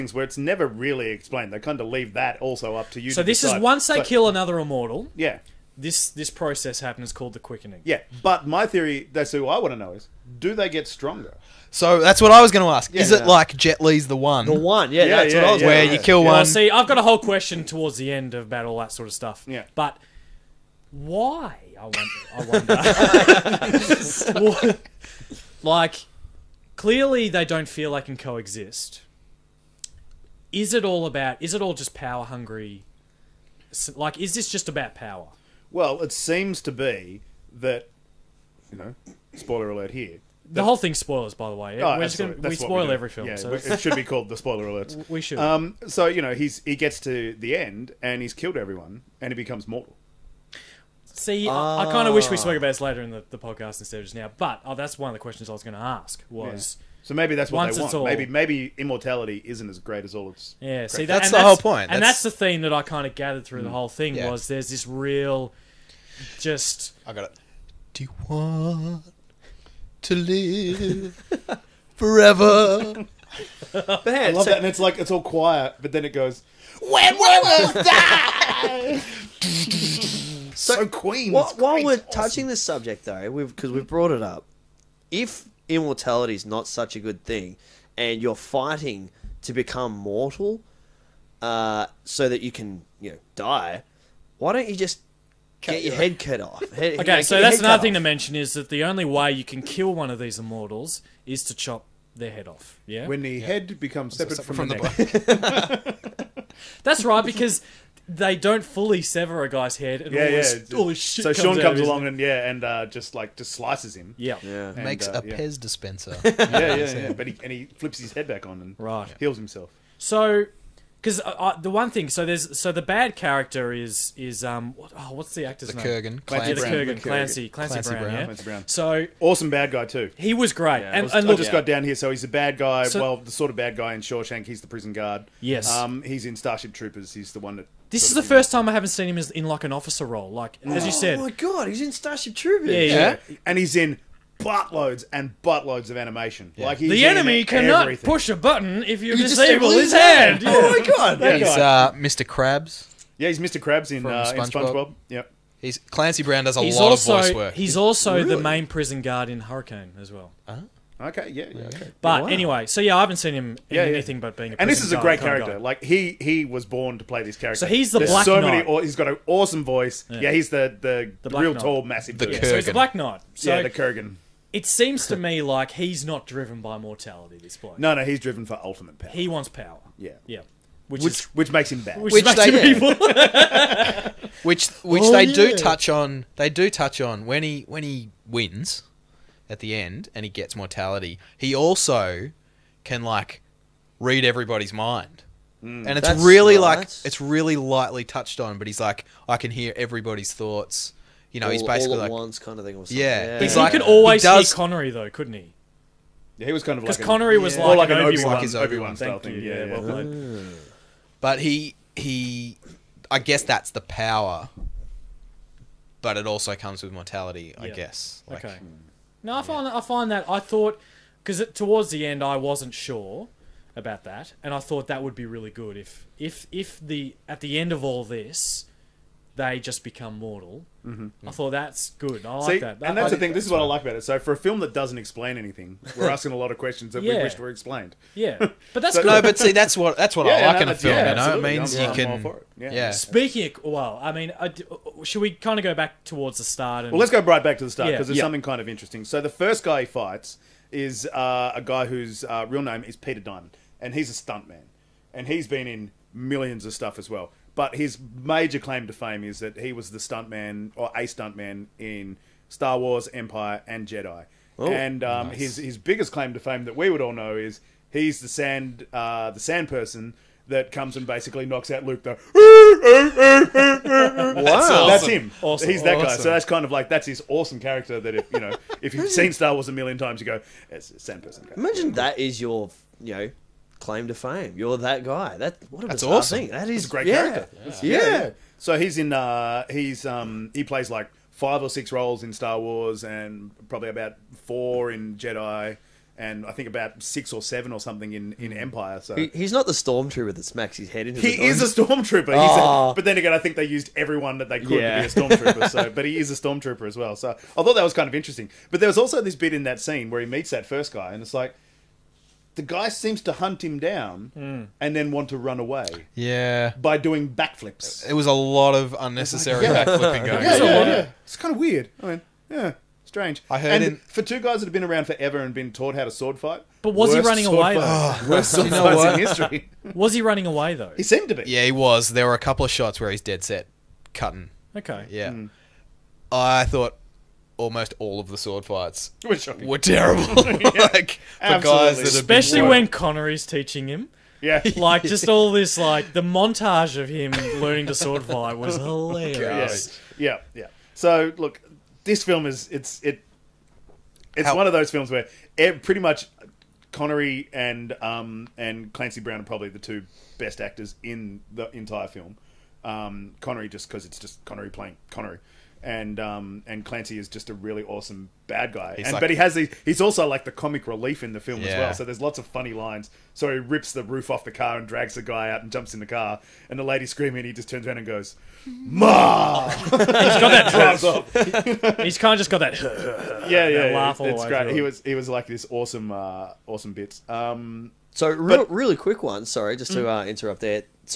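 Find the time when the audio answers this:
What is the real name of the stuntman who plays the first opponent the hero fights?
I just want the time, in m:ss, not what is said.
4:12.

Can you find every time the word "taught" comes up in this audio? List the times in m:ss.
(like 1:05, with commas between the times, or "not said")
5:25.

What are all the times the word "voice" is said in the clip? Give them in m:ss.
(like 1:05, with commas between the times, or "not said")
2:37, 2:49.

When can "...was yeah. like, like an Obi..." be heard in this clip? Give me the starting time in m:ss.
3:27.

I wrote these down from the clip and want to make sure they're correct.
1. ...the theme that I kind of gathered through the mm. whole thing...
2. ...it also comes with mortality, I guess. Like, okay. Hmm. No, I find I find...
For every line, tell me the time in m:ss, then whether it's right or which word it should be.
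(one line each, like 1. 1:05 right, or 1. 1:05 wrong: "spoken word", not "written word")
1. 1:02 right
2. 3:36 right.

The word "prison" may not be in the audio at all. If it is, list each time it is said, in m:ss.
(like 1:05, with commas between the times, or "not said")
2:14, 2:38.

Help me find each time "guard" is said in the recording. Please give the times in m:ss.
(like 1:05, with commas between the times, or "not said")
2:14, 2:39.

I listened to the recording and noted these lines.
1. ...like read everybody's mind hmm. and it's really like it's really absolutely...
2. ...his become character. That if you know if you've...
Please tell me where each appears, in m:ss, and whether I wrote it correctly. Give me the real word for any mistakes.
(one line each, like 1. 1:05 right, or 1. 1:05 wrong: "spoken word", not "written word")
1. 3:13 wrong: "lightly", not "absolutely"
2. 4:37 wrong: "awesome", not "become".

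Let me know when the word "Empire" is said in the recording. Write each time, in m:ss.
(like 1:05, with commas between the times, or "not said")
4:23, 4:58.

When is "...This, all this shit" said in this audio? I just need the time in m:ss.
1:50.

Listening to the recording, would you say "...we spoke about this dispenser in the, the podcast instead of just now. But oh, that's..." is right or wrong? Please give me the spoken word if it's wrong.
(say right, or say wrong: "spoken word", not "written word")
wrong: "later", not "dispenser".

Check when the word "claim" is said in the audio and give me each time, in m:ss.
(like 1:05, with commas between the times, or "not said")
4:18, 4:26, 4:43.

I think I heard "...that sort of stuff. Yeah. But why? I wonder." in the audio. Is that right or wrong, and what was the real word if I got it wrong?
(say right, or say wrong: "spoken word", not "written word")
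right.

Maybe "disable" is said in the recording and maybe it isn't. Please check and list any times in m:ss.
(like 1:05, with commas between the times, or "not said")
2:29.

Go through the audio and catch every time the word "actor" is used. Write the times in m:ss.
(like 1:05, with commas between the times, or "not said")
2:05, 6:00.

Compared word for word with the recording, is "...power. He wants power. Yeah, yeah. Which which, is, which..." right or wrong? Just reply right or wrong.
right.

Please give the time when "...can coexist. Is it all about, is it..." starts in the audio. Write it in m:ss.
0:28.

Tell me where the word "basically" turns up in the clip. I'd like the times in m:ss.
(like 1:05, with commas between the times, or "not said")
3:21, 4:31.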